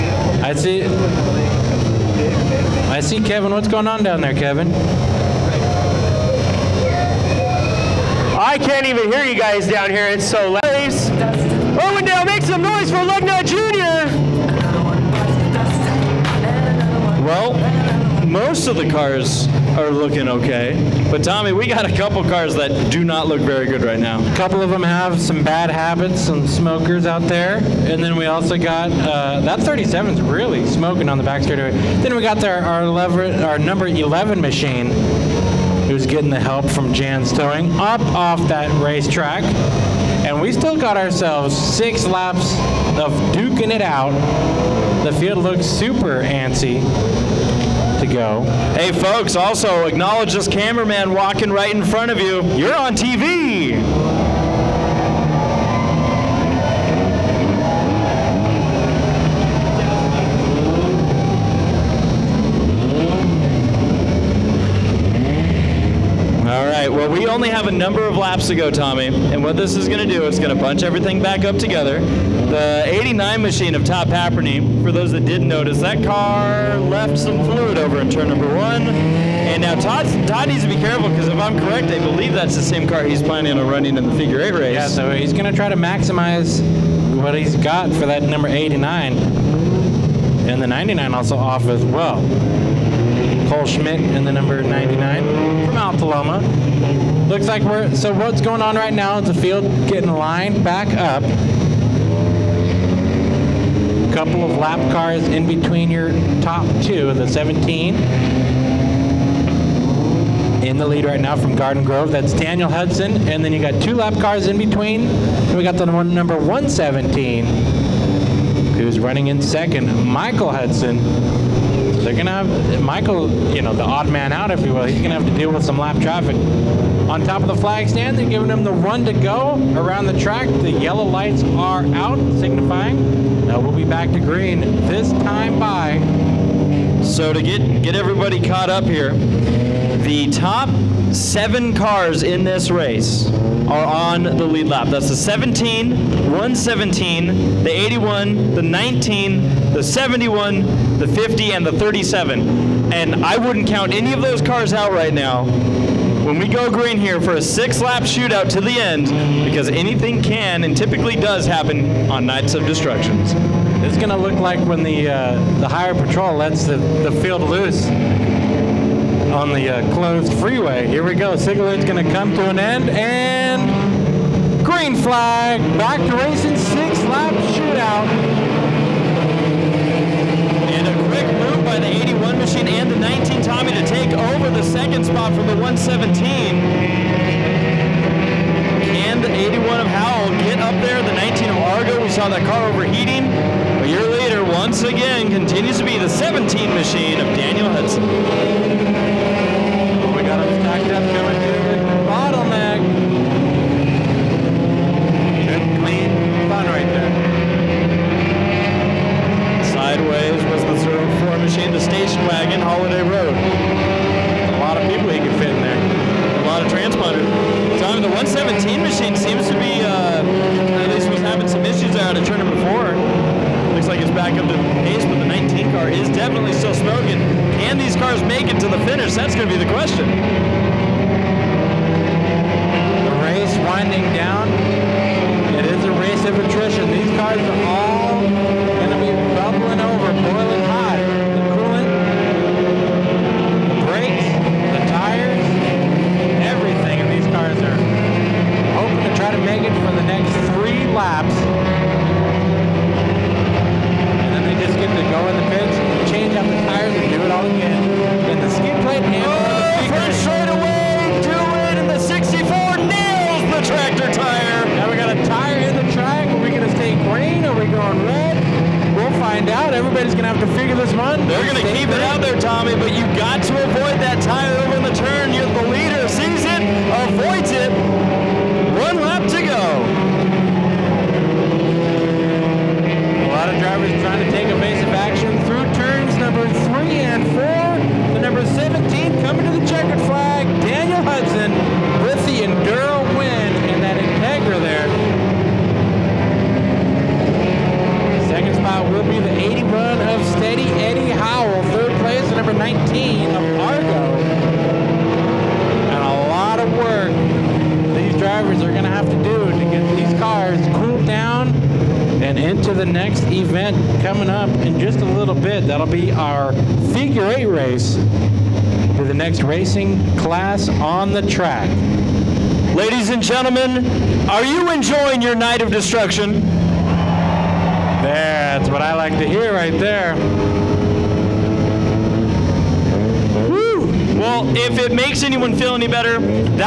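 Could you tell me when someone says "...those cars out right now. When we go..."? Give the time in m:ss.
2:34.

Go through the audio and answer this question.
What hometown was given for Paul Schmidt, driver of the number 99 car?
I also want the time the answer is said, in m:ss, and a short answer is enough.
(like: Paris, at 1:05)
Alta Loma, at 1:35.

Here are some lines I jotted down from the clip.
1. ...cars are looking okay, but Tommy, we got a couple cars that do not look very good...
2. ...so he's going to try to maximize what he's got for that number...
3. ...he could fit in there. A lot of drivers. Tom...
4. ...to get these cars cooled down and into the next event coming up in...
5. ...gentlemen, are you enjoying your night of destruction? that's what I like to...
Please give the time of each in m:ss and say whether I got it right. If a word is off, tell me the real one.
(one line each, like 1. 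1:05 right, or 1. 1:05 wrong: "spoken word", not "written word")
1. 0:18 right
2. 1:24 right
3. 3:35 wrong: "transponders", not "drivers"
4. 5:09 right
5. 5:23 right.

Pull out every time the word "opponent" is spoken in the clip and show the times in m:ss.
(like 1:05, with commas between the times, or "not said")
not said.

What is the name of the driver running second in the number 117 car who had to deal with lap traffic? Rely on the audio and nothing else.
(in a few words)
Michael Hudson.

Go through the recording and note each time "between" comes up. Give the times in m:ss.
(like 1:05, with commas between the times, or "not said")
1:45, 1:54.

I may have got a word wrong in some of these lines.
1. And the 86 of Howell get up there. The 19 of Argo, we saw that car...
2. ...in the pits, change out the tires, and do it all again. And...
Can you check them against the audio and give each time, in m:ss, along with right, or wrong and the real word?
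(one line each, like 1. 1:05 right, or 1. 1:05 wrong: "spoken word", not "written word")
1. 3:08 wrong: "81", not "86"
2. 4:15 right.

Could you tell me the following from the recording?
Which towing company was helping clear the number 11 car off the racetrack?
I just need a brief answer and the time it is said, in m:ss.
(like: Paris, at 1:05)
Jan's Towing, at 0:36.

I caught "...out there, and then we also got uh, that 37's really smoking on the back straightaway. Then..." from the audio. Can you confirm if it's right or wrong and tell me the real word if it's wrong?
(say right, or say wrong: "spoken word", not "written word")
right.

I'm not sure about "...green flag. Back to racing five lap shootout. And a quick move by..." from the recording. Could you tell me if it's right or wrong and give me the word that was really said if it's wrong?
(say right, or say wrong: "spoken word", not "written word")
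wrong: "six", not "five".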